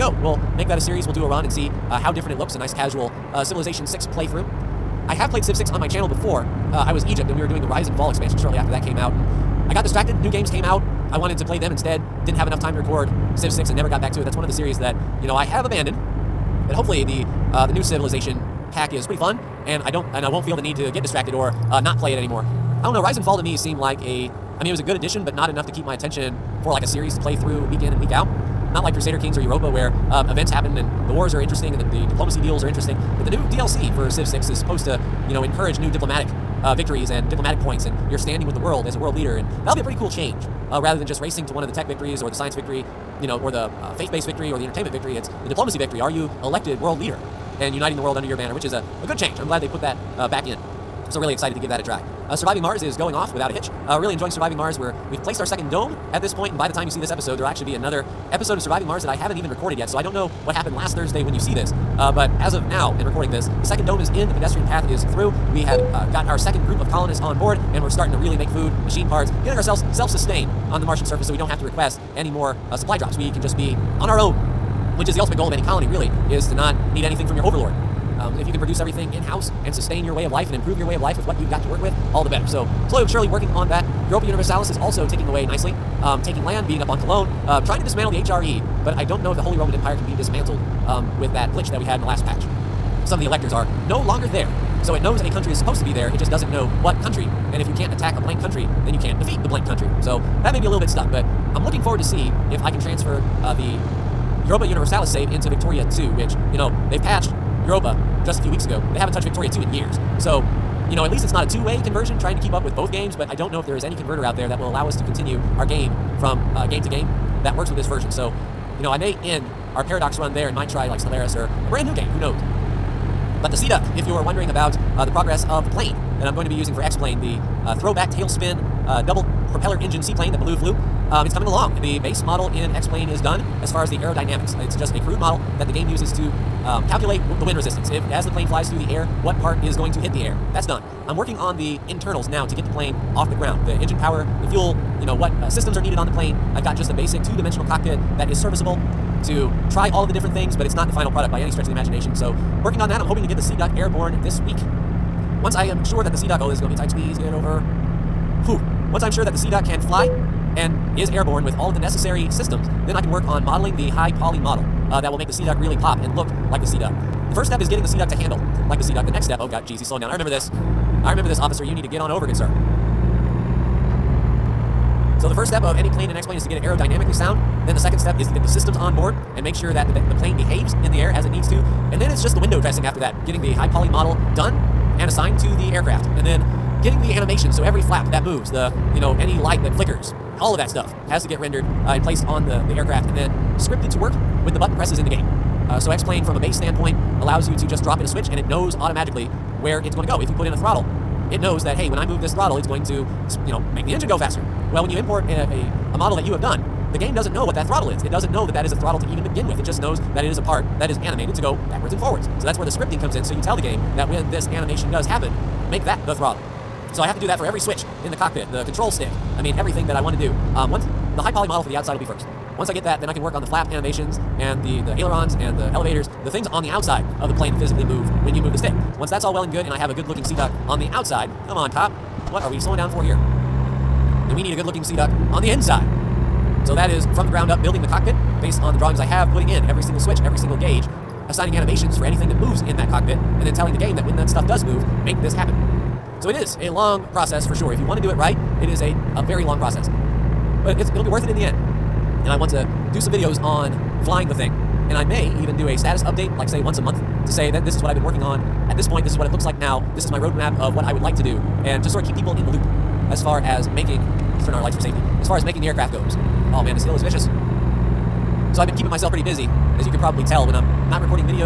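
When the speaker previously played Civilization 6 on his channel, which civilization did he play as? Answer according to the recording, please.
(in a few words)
Egypt.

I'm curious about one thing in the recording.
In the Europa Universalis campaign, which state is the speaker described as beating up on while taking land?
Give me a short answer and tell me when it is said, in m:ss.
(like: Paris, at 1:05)
Cologne, at 1:27.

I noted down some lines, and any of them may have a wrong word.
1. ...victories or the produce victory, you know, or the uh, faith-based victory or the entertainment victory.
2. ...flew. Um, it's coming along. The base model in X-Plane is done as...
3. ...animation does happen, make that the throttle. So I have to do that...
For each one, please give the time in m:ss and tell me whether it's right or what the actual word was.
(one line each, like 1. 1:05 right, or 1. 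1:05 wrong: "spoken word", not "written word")
1. 0:41 wrong: "science", not "produce"
2. 2:10 right
3. 3:34 right.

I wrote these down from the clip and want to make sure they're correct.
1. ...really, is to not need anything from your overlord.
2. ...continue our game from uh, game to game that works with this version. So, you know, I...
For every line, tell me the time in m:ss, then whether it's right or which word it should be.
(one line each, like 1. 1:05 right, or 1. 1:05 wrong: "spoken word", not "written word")
1. 1:15 right
2. 1:55 right.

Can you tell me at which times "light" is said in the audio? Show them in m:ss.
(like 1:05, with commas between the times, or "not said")
3:09, 4:24.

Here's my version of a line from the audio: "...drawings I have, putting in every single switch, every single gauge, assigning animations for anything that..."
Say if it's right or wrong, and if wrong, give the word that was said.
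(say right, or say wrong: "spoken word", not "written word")
right.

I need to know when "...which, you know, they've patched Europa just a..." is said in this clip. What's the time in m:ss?
1:46.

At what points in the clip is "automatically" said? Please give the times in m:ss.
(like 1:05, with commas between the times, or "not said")
3:18.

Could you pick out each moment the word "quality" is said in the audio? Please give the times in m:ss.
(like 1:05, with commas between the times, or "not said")
not said.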